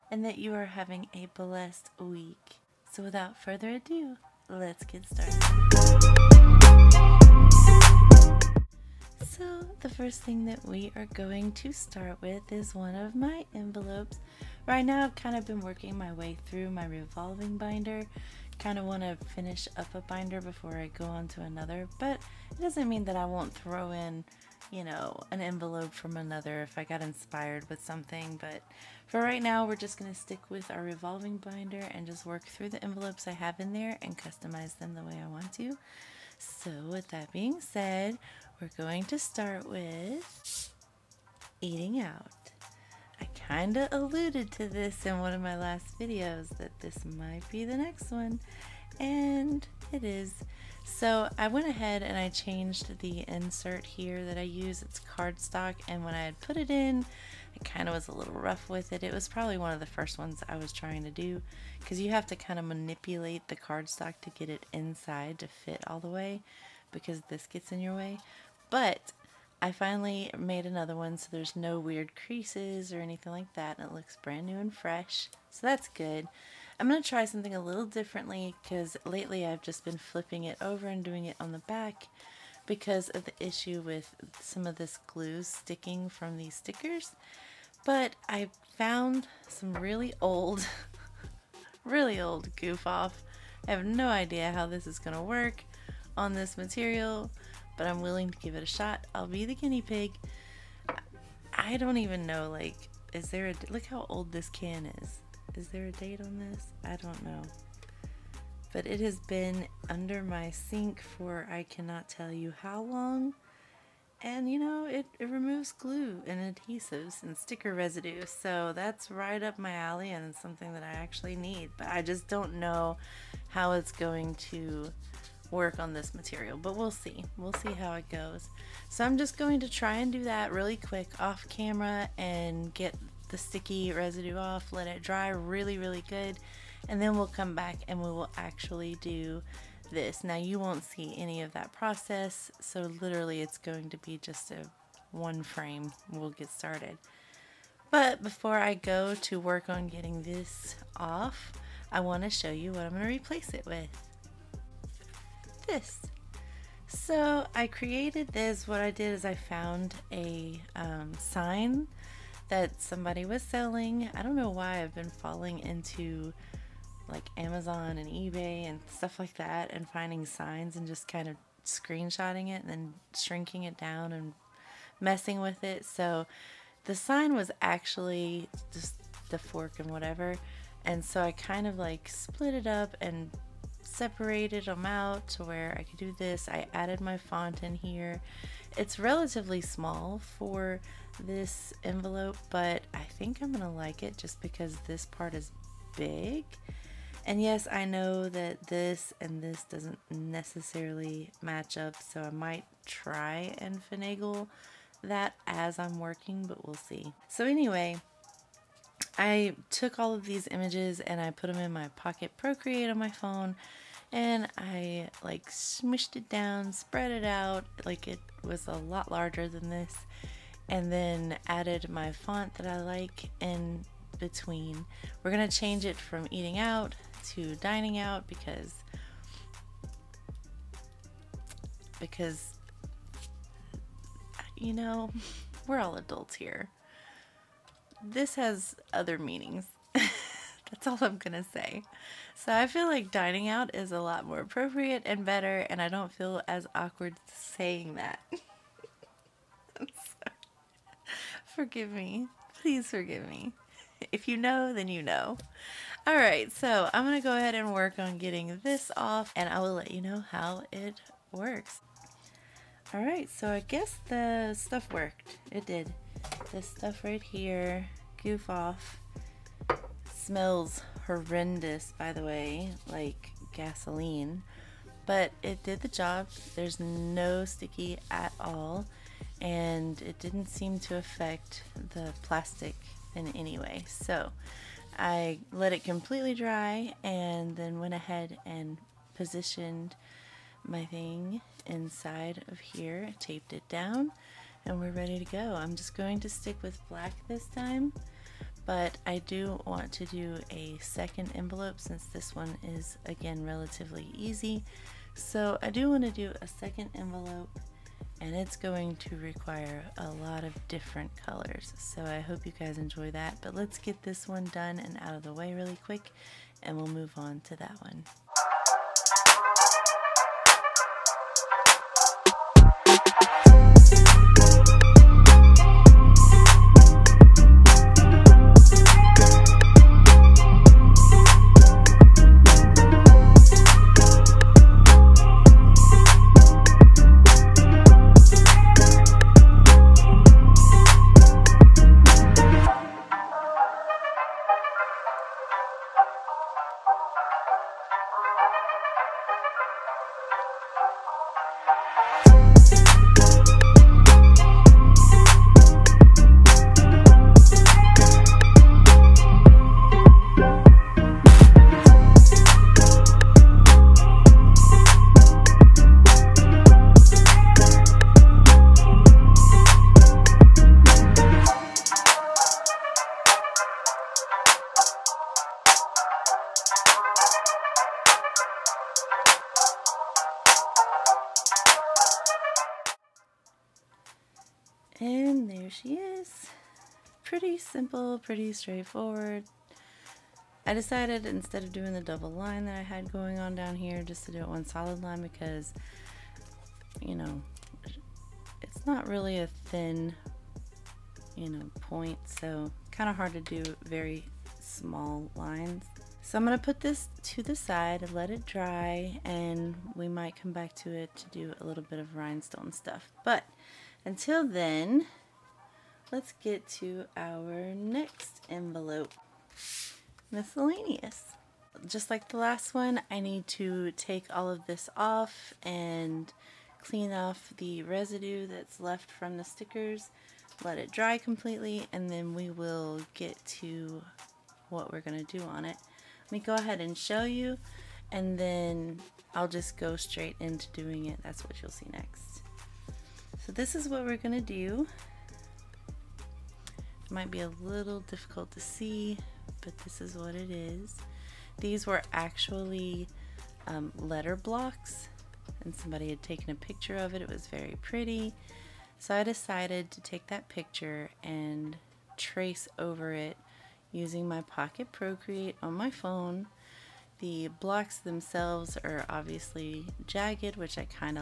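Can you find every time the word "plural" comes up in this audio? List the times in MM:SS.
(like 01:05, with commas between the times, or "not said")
not said.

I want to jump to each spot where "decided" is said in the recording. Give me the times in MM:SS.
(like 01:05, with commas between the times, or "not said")
06:30, 07:39.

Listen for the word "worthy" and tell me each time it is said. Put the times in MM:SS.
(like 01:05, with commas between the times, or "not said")
not said.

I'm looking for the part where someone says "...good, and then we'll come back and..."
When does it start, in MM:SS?
02:16.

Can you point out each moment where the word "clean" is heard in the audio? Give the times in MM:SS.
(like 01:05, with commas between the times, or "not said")
07:06.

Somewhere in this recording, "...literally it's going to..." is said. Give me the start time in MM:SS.
02:23.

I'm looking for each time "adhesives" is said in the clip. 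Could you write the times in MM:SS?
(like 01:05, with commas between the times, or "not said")
01:56.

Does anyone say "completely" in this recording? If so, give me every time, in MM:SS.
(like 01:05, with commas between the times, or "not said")
04:45, 07:11.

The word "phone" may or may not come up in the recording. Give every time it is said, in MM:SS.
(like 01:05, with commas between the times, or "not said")
03:33, 07:45.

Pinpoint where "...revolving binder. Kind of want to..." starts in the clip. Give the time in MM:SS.
00:16.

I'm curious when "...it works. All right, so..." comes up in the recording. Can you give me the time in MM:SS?
04:20.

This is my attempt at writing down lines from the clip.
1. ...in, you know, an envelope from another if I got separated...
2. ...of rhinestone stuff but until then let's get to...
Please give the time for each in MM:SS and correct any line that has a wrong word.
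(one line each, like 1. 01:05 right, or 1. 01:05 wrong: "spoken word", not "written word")
1. 00:23 wrong: "inspired", not "separated"
2. 06:51 right.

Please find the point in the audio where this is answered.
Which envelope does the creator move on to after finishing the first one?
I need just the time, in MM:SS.
07:00.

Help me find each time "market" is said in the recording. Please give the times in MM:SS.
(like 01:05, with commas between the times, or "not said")
not said.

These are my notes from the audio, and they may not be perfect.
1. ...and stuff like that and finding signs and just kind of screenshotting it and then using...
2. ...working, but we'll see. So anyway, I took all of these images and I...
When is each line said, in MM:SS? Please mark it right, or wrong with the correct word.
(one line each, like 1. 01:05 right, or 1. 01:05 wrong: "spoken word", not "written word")
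1. 02:48 wrong: "shrinking", not "using"
2. 03:25 right.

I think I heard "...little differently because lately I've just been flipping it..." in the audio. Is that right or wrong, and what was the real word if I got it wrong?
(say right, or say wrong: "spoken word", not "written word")
right.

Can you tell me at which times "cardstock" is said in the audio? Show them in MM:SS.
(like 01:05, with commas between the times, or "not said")
00:55, 01:03.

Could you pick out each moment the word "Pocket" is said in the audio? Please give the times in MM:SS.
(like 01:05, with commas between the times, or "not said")
03:31, 07:44.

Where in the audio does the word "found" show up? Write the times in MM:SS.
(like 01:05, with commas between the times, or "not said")
01:28, 02:39.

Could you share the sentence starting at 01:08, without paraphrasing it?
But I finally made another one so there's no weird creases or anything like that.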